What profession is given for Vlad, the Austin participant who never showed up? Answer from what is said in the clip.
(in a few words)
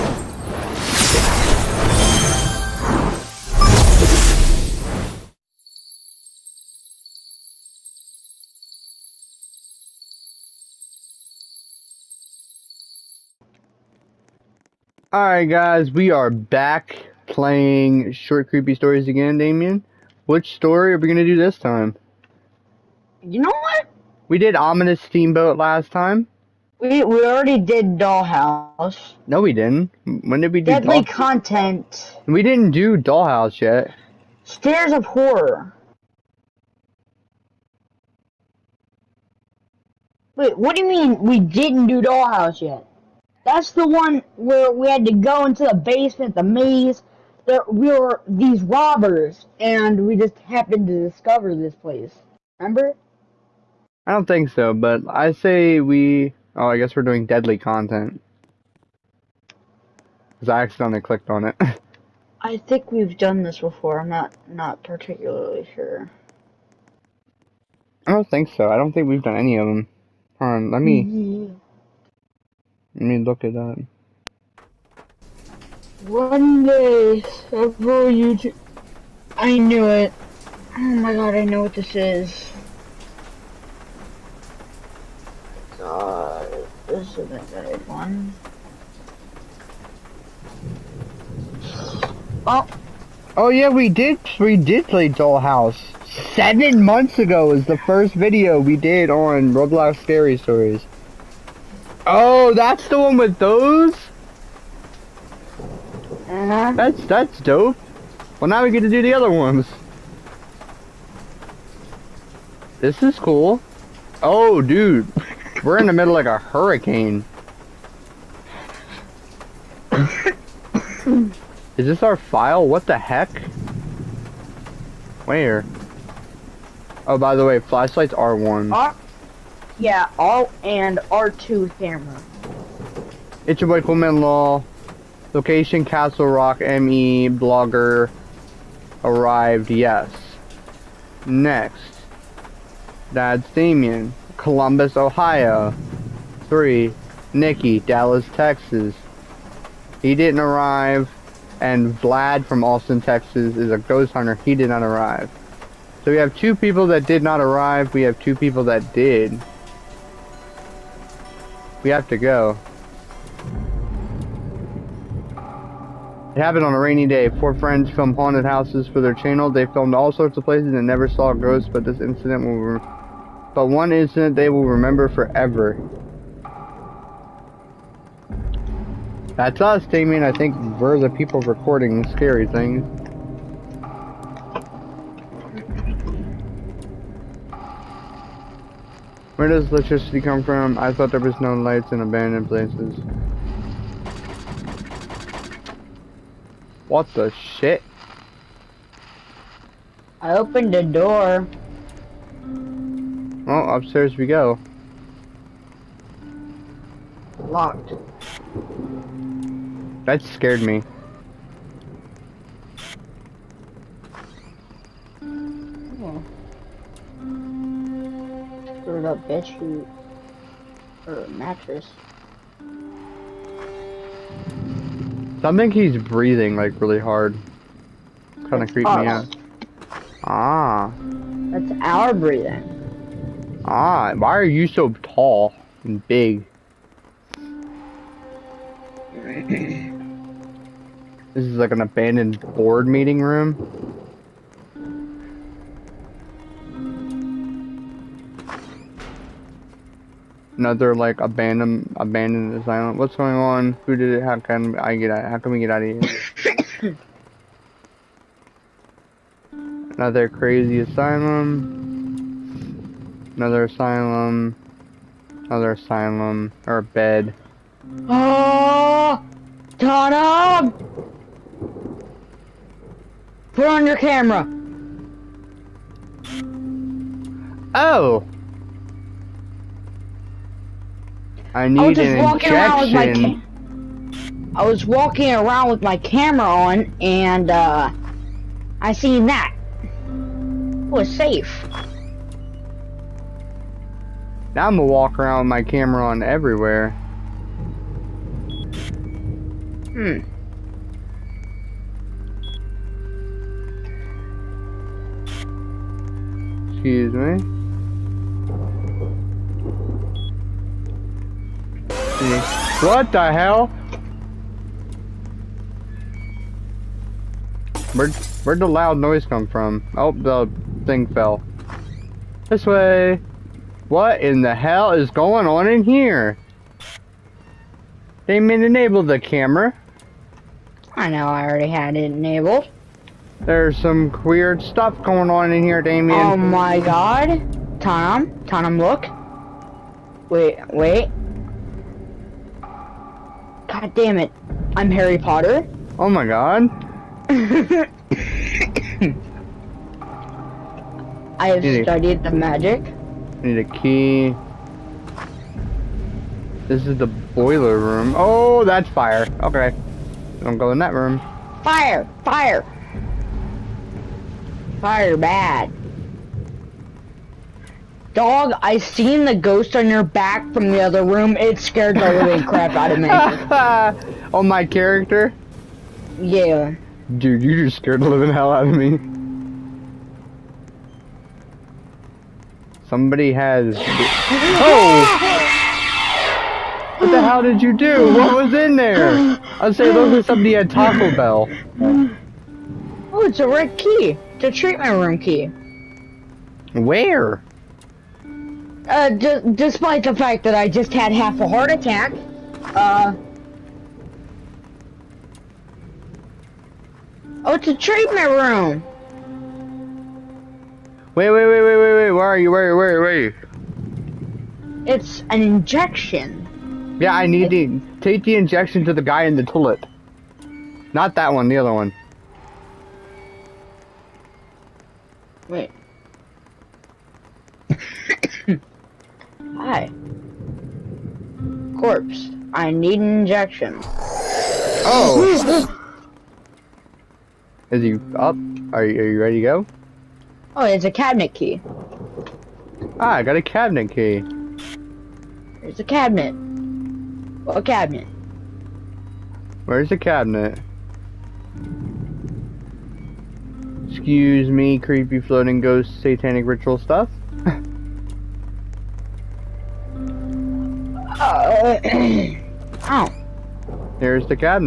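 ghost hunter.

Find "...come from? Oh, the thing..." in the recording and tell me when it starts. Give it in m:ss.
5:19.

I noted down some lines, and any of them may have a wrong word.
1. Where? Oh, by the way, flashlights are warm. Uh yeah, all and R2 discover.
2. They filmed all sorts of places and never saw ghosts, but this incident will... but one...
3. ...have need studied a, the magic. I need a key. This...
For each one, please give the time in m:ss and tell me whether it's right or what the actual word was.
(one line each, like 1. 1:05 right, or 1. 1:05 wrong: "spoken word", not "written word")
1. 2:05 wrong: "hammer", not "discover"
2. 2:49 right
3. 5:51 right.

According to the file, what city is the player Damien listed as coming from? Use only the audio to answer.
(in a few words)
Columbus, Ohio.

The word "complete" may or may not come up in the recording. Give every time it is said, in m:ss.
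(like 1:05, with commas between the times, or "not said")
not said.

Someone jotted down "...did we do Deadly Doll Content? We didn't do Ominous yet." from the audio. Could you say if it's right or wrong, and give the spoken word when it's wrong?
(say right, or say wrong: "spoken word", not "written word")
wrong: "Dollhouse", not "Ominous".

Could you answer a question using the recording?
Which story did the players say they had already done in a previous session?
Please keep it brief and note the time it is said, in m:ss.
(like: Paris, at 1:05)
Ominous Steamboat, at 0:24.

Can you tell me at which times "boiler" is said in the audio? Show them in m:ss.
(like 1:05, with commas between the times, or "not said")
5:57.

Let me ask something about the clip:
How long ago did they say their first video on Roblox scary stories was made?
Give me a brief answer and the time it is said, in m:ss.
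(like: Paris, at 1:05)
Seven months ago, at 1:36.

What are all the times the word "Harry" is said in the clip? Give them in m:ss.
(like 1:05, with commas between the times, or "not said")
5:44.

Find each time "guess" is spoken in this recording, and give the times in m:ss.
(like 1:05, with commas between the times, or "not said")
0:56.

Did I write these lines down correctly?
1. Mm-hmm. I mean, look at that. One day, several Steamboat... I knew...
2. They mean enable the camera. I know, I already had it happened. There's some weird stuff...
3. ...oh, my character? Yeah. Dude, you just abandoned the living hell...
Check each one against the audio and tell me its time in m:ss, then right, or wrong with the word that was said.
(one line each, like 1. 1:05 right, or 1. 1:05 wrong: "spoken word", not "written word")
1. 1:11 wrong: "YouTube", not "Steamboat"
2. 5:28 wrong: "enabled", not "happened"
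3. 6:14 wrong: "scared", not "abandoned".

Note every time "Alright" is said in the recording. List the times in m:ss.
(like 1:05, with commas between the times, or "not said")
0:15.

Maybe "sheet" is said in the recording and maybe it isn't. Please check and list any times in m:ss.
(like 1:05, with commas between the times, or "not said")
3:39.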